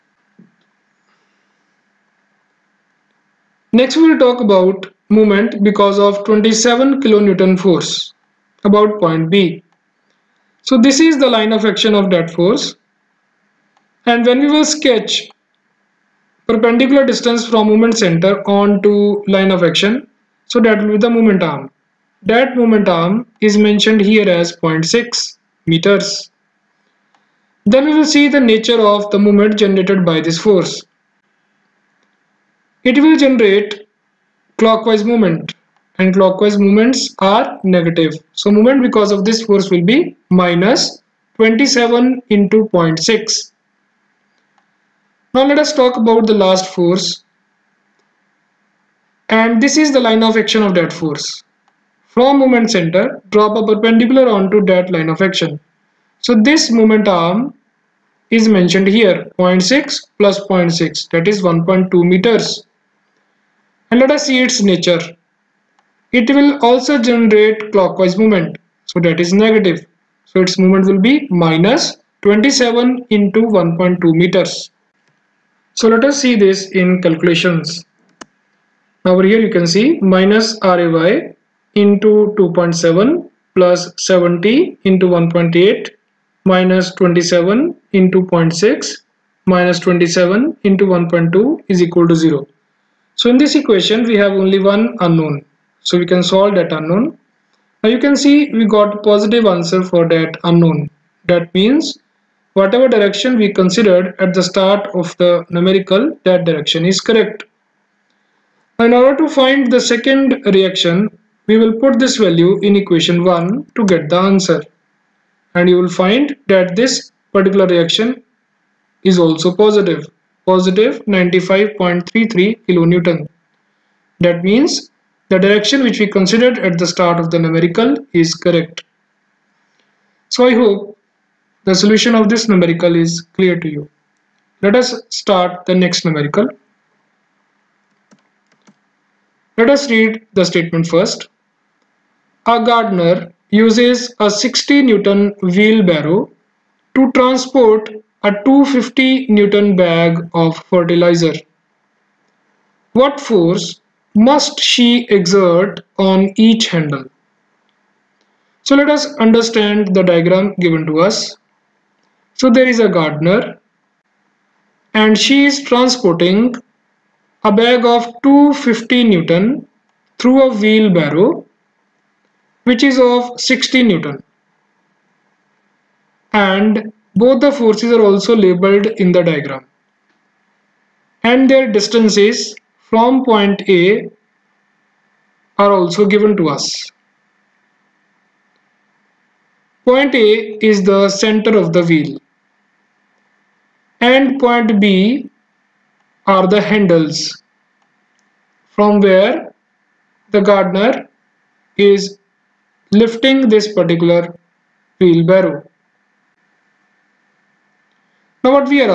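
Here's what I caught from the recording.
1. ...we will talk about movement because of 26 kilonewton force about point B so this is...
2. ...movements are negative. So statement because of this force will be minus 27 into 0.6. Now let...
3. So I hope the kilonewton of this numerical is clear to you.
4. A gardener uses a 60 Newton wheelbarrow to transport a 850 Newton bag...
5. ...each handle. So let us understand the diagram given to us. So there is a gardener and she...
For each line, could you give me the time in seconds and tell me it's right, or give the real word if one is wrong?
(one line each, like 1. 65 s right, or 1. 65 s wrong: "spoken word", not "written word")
1. 3 s wrong: "27", not "26"
2. 36 s wrong: "movement", not "statement"
3. 130 s wrong: "solution", not "kilonewton"
4. 142 s wrong: "250", not "850"
5. 156 s right.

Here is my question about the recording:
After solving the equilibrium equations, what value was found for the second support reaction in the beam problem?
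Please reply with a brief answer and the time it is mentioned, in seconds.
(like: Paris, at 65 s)
95.33 kilonewton, at 121 s.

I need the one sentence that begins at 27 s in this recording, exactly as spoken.
Then we will see the nature of the moment generated by this force.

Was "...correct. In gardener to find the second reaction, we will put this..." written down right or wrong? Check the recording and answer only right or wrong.
wrong.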